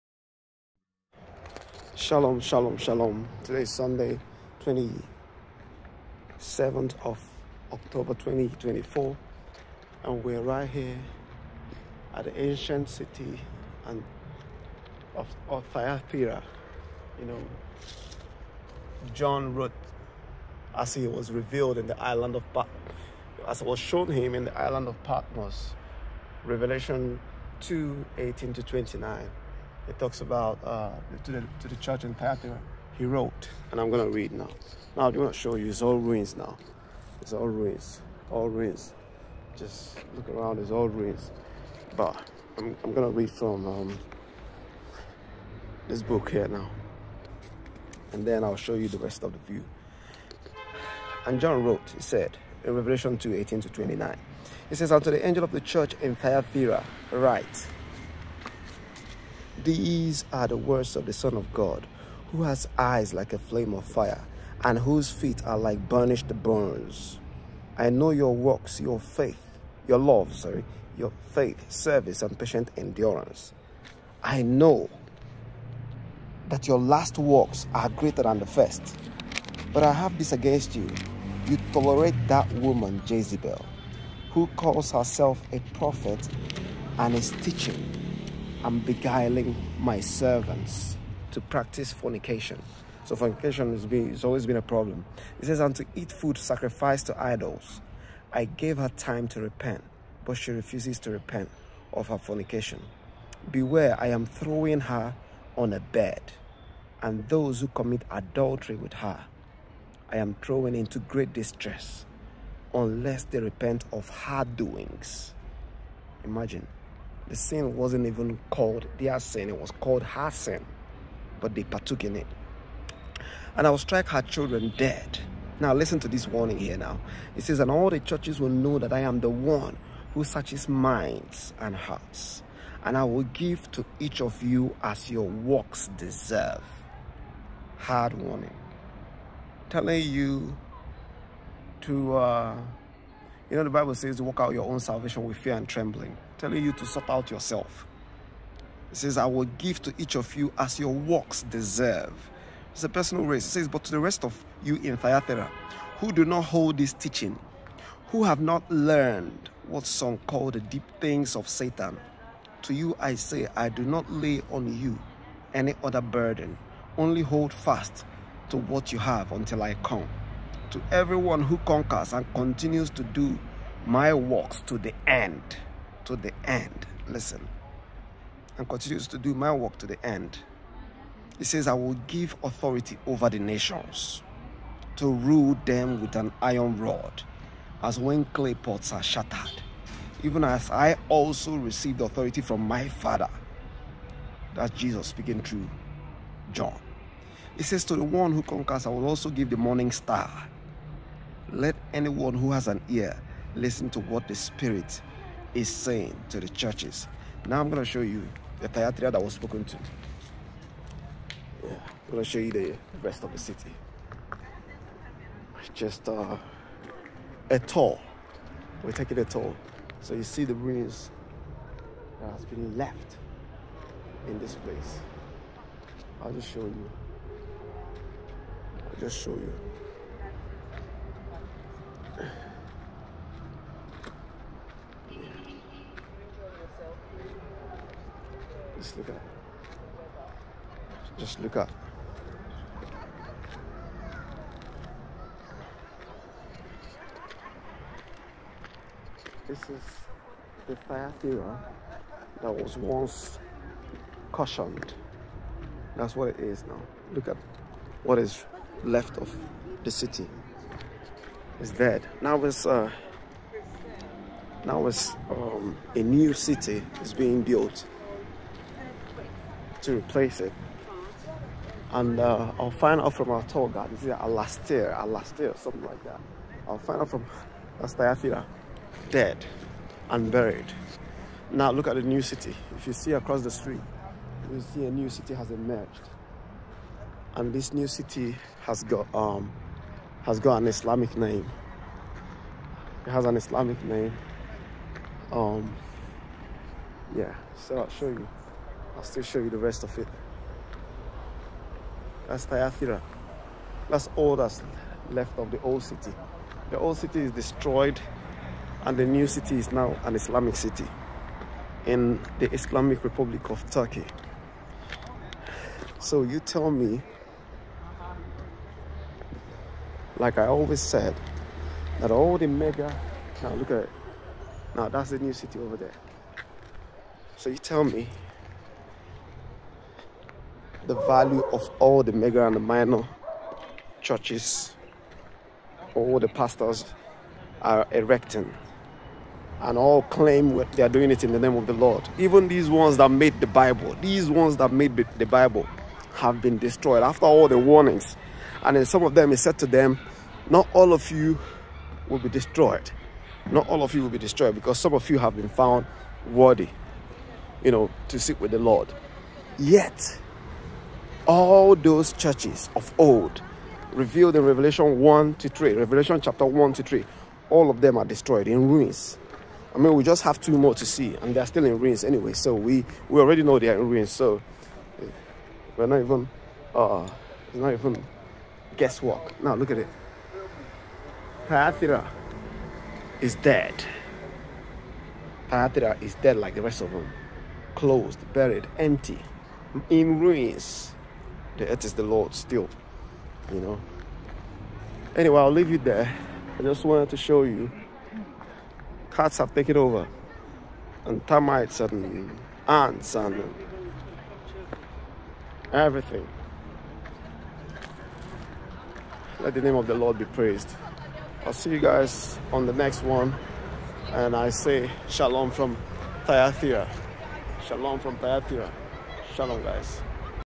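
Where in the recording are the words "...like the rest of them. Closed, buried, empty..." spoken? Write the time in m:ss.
6:26.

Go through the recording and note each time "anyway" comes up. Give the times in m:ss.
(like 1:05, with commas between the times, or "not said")
6:12, 6:35.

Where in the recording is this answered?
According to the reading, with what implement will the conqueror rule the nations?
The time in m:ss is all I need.
3:06.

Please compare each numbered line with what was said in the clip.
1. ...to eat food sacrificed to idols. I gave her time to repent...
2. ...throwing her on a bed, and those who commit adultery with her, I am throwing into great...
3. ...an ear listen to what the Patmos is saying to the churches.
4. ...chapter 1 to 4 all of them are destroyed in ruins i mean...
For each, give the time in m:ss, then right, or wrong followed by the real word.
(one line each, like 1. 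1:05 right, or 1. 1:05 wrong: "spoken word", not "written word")
1. 1:35 right
2. 1:44 right
3. 3:22 wrong: "Spirit", not "Patmos"
4. 6:06 wrong: "3", not "4".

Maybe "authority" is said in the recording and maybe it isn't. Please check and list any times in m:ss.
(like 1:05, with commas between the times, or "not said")
3:02, 3:12.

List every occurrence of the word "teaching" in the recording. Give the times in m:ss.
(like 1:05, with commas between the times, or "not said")
1:27, 2:36.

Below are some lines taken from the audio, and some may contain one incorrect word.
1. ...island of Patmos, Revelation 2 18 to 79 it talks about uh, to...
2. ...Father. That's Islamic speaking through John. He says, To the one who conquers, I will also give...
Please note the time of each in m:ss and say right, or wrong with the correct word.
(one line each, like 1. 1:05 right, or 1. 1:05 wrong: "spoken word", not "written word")
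1. 0:24 wrong: "29", not "79"
2. 3:12 wrong: "Jesus", not "Islamic".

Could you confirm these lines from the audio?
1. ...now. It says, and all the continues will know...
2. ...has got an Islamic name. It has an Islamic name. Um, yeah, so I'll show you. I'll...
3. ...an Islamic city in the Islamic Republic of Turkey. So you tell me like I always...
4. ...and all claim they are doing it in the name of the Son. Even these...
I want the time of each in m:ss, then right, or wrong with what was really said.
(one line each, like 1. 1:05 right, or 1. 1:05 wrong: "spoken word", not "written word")
1. 2:06 wrong: "churches", not "continues"
2. 4:50 right
3. 5:10 right
4. 5:39 wrong: "Lord", not "Son".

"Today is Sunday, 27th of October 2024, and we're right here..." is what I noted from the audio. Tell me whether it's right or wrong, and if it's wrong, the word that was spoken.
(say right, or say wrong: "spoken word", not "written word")
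right.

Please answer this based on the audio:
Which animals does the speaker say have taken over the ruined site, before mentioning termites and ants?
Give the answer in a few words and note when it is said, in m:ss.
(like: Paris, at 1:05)
Cats, at 6:39.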